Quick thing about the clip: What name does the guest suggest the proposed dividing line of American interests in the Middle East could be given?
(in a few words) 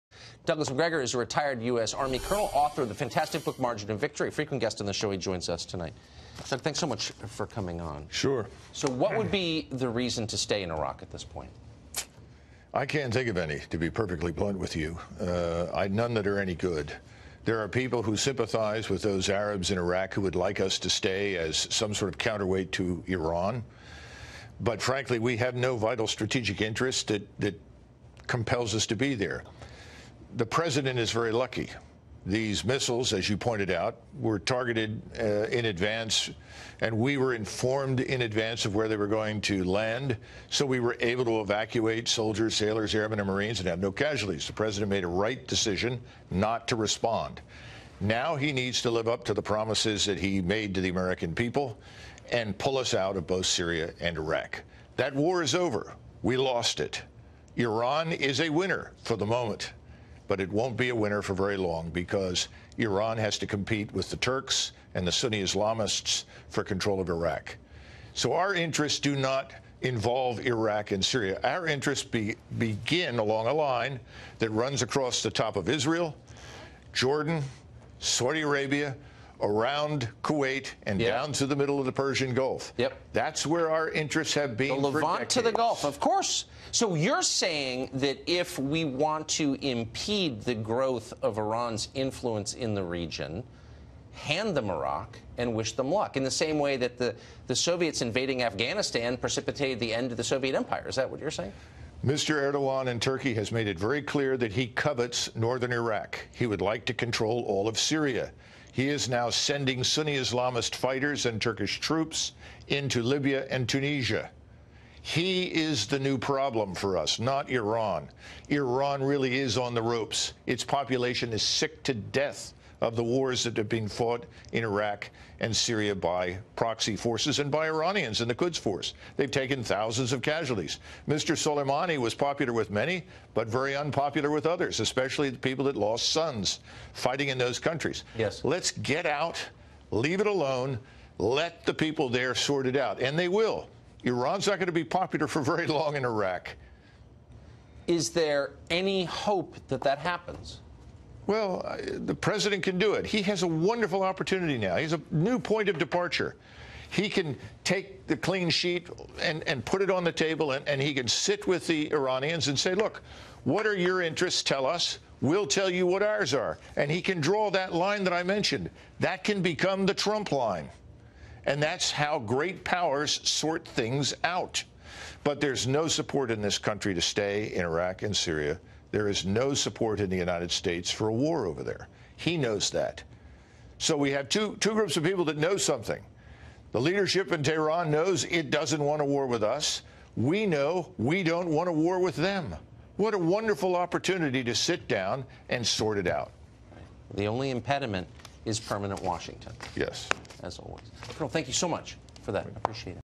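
The Trump line.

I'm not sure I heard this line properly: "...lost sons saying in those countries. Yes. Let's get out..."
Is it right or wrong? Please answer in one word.
wrong.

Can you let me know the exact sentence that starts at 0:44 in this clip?
The president made a right decision not to respond.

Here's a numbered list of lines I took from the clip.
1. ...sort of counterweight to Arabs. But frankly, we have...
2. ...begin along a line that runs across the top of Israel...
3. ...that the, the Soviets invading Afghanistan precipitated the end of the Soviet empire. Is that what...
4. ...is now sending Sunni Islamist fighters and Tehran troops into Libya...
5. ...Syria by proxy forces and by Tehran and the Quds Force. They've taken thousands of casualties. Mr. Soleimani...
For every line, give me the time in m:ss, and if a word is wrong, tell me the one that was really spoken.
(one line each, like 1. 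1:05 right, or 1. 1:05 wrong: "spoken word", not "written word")
1. 0:21 wrong: "Iran", not "Arabs"
2. 1:12 right
3. 1:36 right
4. 1:48 wrong: "Turkish", not "Tehran"
5. 2:05 wrong: "Iranians", not "Tehran".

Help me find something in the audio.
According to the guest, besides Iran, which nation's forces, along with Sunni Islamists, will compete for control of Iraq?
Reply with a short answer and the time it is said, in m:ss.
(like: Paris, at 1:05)
The Turks, at 1:04.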